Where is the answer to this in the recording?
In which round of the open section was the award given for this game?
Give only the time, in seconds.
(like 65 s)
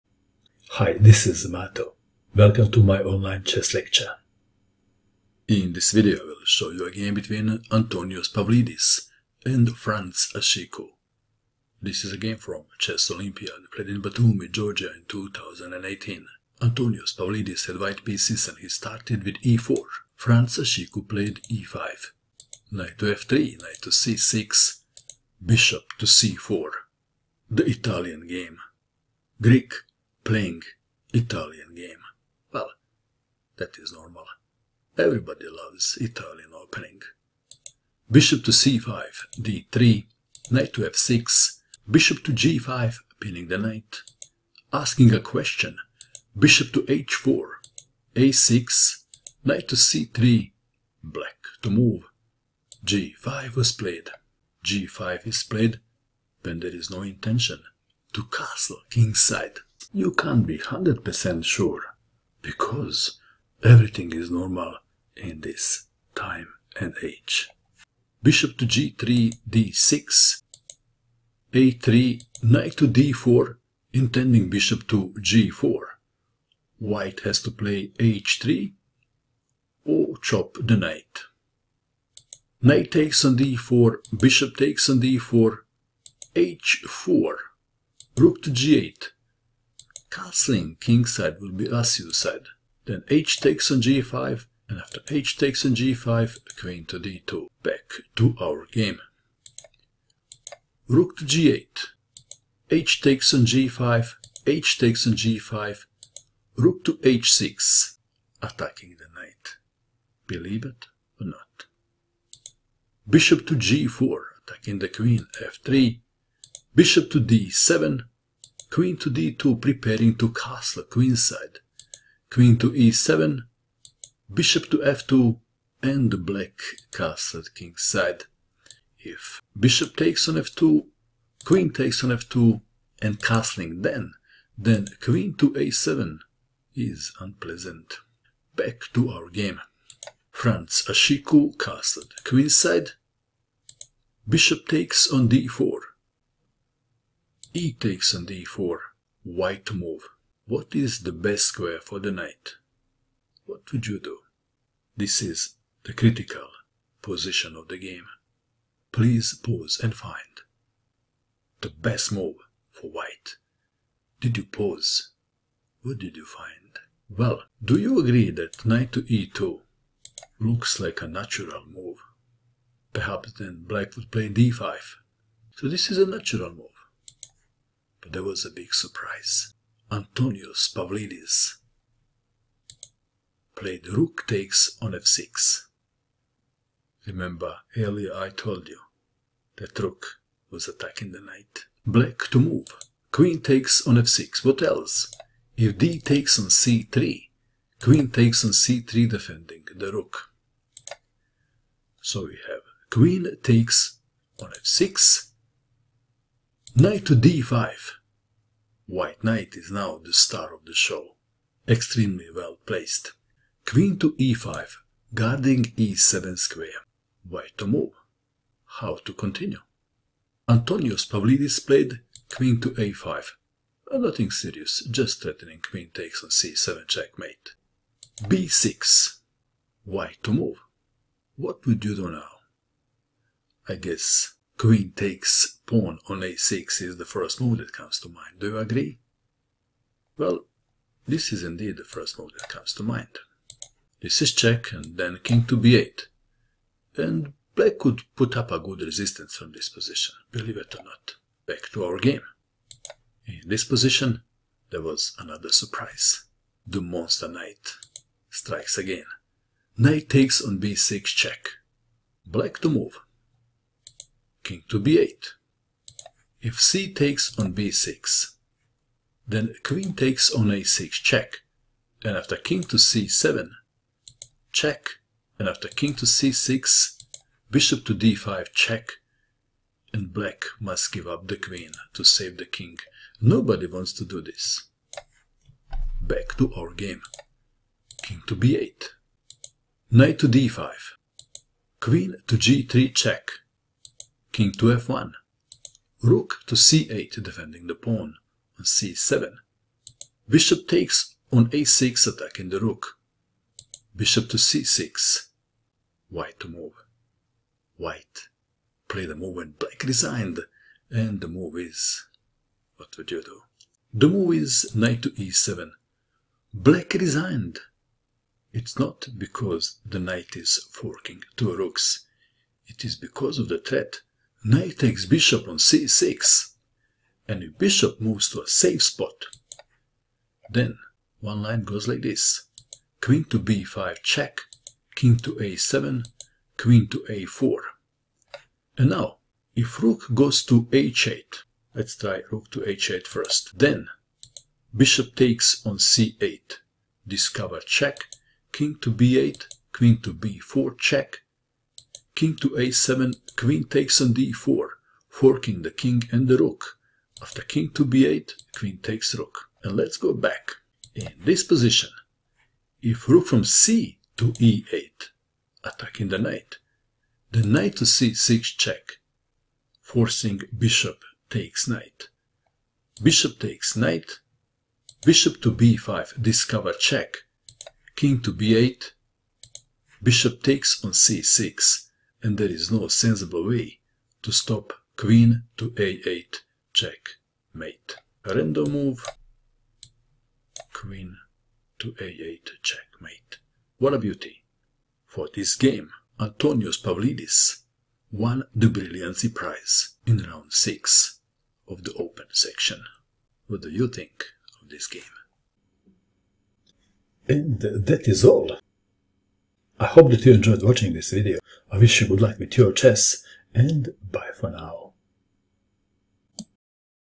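400 s.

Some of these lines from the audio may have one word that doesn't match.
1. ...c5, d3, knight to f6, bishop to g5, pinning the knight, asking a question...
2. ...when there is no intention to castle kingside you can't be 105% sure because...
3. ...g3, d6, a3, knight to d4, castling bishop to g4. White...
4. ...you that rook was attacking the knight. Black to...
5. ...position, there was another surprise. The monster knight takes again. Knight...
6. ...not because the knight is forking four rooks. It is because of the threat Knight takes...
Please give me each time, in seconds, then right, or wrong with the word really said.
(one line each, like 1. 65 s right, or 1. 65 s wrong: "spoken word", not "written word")
1. 38 s right
2. 56 s wrong: "100", not "105"
3. 68 s wrong: "intending", not "castling"
4. 188 s right
5. 253 s wrong: "strikes", not "takes"
6. 318 s wrong: "two", not "four".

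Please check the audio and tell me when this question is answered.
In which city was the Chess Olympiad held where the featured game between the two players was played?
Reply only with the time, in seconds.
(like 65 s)
14 s.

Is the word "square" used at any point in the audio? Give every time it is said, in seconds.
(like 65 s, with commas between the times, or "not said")
151 s, 216 s.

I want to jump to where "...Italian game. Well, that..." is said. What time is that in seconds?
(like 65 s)
31 s.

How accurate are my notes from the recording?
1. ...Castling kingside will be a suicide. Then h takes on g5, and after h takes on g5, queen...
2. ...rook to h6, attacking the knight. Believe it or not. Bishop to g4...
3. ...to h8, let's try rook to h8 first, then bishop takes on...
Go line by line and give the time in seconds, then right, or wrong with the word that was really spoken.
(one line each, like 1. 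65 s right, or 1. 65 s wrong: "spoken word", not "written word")
1. 90 s right
2. 106 s right
3. 340 s right.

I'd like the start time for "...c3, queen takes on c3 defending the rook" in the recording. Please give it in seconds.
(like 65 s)
196 s.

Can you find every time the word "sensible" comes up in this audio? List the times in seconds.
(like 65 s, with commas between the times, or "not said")
382 s.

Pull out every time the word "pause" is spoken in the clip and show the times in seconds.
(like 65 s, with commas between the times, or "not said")
159 s, 164 s.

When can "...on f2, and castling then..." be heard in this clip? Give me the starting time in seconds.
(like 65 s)
132 s.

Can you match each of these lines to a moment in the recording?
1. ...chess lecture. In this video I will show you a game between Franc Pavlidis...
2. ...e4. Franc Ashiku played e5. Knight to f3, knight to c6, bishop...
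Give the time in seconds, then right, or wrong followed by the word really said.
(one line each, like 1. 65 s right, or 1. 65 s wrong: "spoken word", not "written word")
1. 3 s wrong: "Antonios", not "Franc"
2. 19 s right.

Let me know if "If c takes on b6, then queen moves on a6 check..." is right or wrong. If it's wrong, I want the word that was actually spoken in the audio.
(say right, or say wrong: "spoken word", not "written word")
wrong: "takes", not "moves".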